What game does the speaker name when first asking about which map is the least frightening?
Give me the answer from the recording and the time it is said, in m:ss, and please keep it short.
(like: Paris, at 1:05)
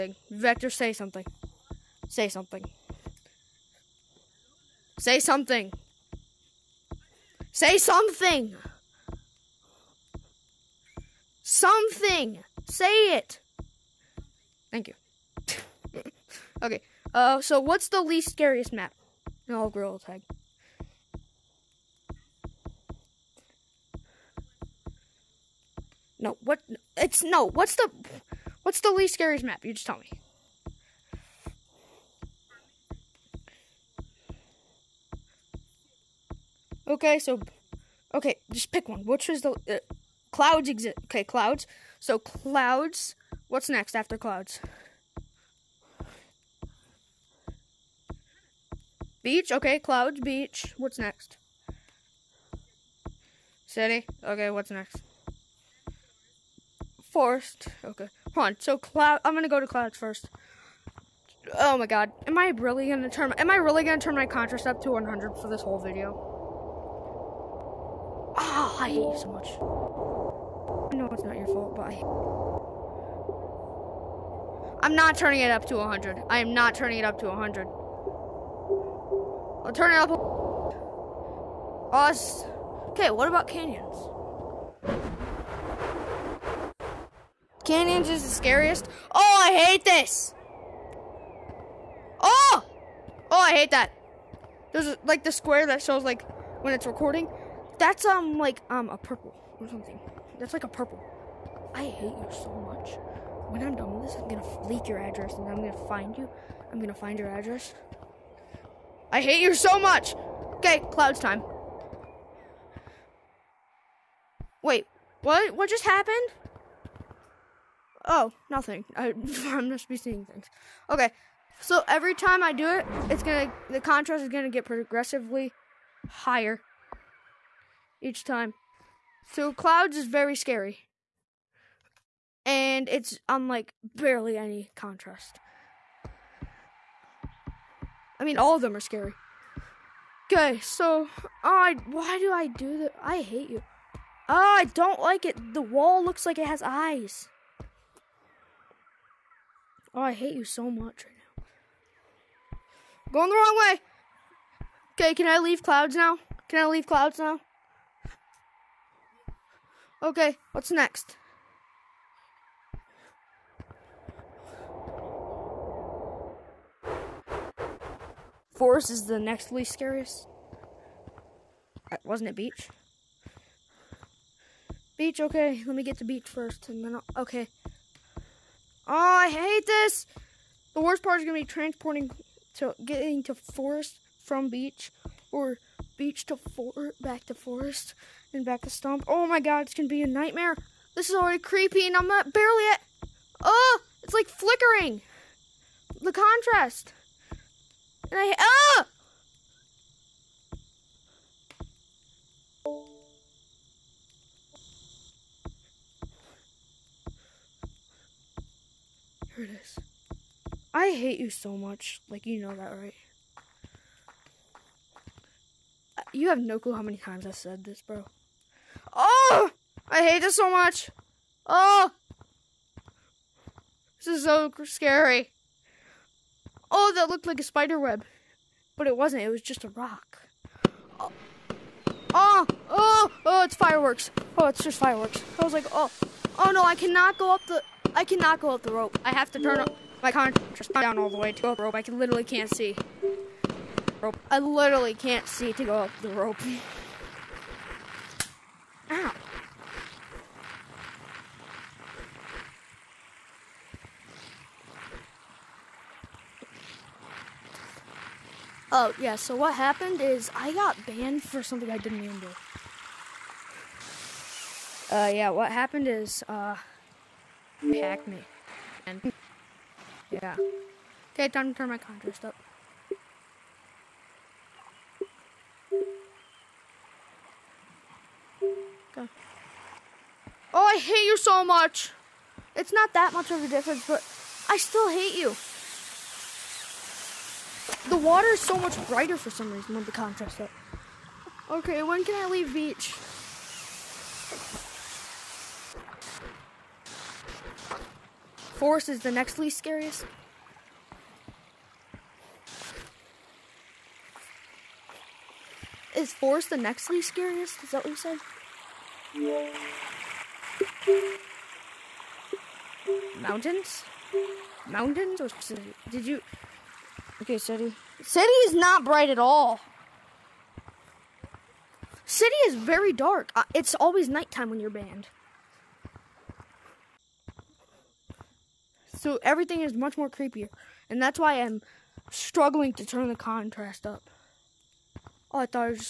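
Gorilla Tag, at 0:19.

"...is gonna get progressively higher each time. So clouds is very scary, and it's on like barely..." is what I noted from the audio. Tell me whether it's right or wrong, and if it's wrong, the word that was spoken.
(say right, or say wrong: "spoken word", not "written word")
right.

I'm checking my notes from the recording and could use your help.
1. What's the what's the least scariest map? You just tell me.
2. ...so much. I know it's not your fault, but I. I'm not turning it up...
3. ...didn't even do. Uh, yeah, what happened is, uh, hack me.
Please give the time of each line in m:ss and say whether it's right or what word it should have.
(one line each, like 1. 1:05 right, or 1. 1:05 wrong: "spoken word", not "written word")
1. 0:27 right
2. 1:09 right
3. 4:21 right.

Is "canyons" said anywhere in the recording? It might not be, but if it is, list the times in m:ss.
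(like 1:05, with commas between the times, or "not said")
1:23, 1:27.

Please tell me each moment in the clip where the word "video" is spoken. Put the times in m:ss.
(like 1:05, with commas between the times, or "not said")
1:05.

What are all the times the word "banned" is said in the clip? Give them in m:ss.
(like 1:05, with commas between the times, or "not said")
4:20, 5:24.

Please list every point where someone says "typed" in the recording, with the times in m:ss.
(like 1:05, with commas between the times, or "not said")
not said.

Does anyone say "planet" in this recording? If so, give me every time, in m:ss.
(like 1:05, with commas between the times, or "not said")
not said.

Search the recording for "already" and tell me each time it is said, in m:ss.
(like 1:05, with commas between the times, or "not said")
3:11.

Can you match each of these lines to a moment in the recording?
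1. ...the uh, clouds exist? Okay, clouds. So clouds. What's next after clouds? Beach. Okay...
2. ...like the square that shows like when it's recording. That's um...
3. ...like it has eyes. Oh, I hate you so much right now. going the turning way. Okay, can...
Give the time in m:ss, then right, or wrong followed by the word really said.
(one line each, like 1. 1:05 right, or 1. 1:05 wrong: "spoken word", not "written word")
1. 0:39 right
2. 1:35 right
3. 2:26 wrong: "wrong", not "turning".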